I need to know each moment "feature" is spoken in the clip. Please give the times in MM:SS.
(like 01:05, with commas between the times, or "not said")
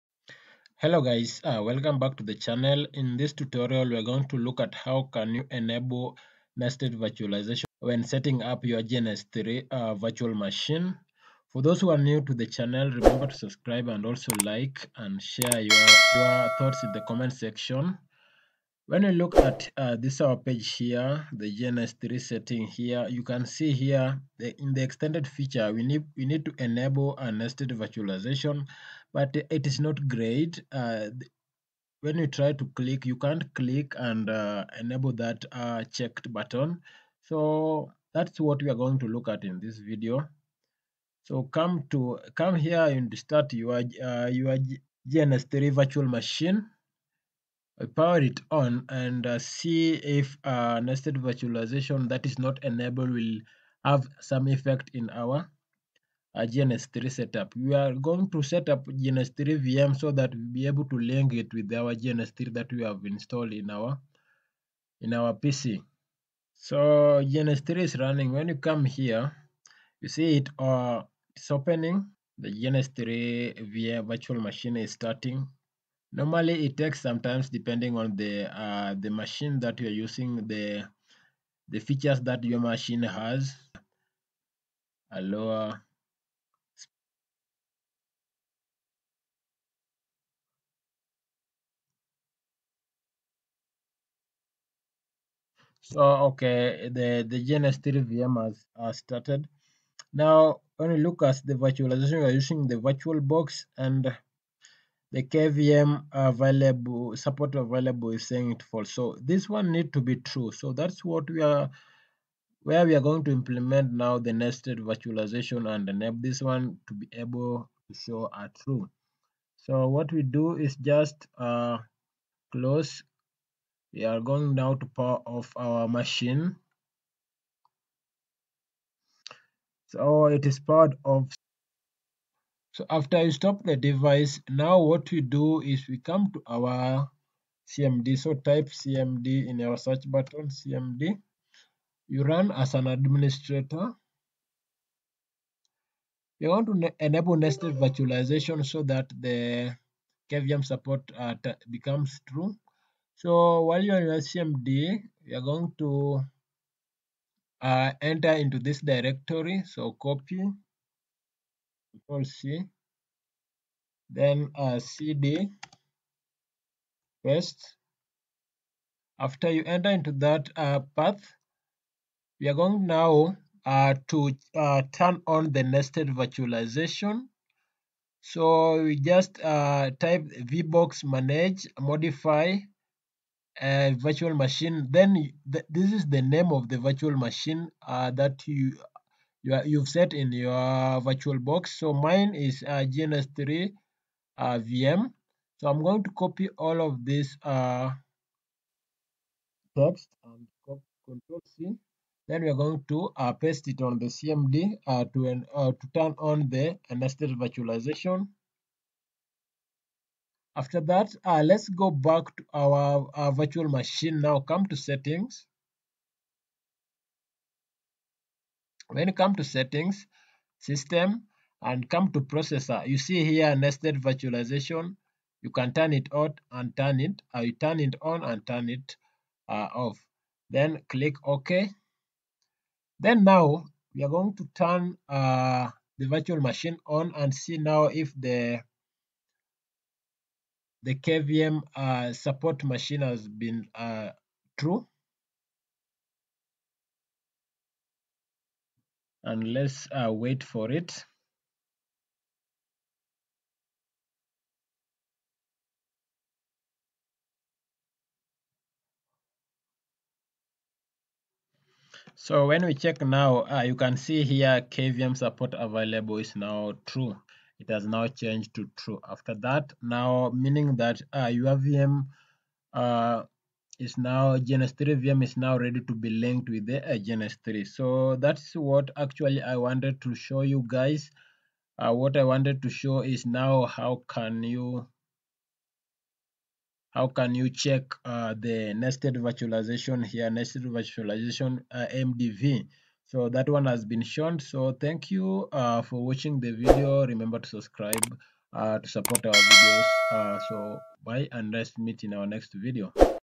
00:25, 01:21.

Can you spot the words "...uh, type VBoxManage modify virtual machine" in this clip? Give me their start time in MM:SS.
02:59.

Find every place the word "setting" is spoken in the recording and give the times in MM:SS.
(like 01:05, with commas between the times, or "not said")
00:08, 00:22, 03:34, 03:39.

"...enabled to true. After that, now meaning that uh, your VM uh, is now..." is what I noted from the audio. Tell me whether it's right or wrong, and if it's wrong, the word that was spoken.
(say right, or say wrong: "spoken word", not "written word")
wrong: "changed", not "enabled".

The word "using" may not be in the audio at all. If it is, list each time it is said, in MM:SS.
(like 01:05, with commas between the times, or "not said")
01:19, 01:42.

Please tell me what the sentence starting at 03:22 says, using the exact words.
Then we're going to uh, paste it on the CMD uh, to, an, uh, to turn on the nested virtualization.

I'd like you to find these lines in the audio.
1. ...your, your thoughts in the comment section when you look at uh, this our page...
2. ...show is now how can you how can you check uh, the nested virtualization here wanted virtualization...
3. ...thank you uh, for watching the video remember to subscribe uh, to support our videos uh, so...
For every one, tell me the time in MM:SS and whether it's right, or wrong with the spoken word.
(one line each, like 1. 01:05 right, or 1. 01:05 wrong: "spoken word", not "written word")
1. 00:15 right
2. 04:42 wrong: "nested", not "wanted"
3. 04:54 right.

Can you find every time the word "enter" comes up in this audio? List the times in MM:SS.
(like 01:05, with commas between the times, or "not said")
02:38, 02:49.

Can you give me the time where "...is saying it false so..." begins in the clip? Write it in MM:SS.
01:48.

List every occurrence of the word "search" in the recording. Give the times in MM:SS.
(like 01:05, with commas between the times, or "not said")
02:19.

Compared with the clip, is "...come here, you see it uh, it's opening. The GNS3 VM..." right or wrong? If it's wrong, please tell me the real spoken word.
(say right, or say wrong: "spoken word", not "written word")
right.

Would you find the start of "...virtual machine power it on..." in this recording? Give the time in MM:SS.
00:45.